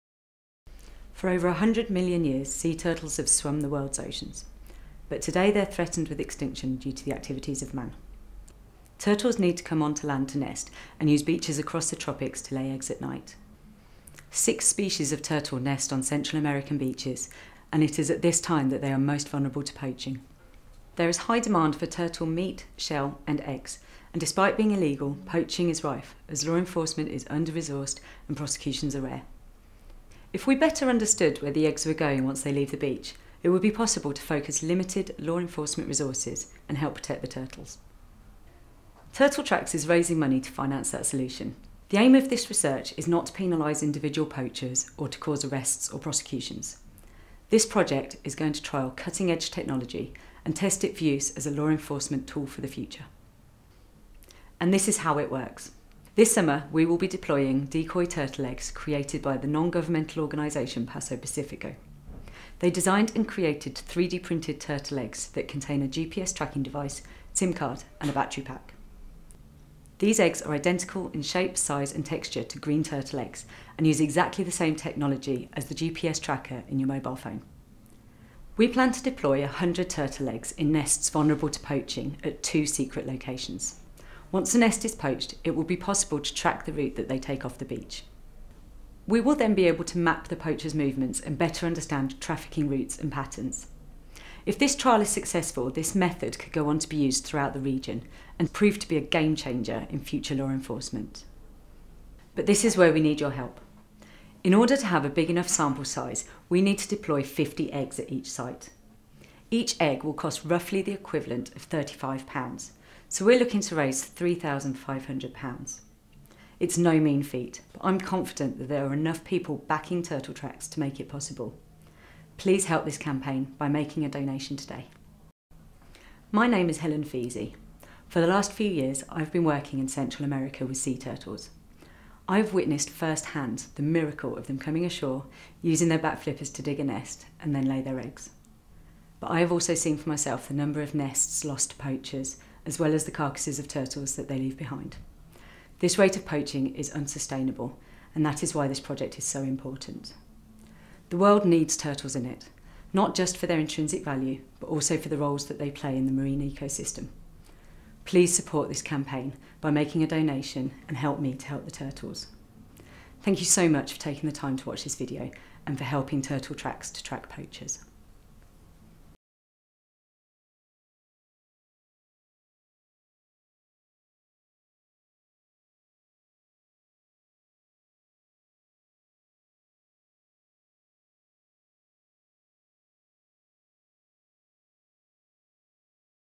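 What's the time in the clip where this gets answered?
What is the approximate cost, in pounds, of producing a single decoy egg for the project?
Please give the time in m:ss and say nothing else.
1:51.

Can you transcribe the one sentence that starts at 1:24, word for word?
Once a nest is poached, it will be possible to track the route that they take off the beach.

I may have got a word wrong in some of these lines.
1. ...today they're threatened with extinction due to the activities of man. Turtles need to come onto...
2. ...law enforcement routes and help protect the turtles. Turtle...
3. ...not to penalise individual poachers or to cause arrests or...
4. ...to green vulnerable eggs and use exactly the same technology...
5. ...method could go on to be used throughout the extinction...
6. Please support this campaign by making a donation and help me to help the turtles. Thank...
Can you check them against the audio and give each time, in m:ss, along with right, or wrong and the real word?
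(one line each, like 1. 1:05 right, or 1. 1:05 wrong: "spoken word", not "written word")
1. 0:05 right
2. 0:35 wrong: "resources", not "routes"
3. 0:43 right
4. 1:12 wrong: "turtle", not "vulnerable"
5. 1:35 wrong: "region", not "extinction"
6. 2:38 right.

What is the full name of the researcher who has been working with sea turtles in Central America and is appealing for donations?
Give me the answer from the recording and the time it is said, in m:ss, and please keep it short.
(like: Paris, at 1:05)
Helen Pheasey, at 2:06.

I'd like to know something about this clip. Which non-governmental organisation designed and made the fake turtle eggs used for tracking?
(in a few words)
Paso Pacifico.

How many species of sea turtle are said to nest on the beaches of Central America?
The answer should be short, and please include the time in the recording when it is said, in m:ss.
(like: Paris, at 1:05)
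6, at 0:14.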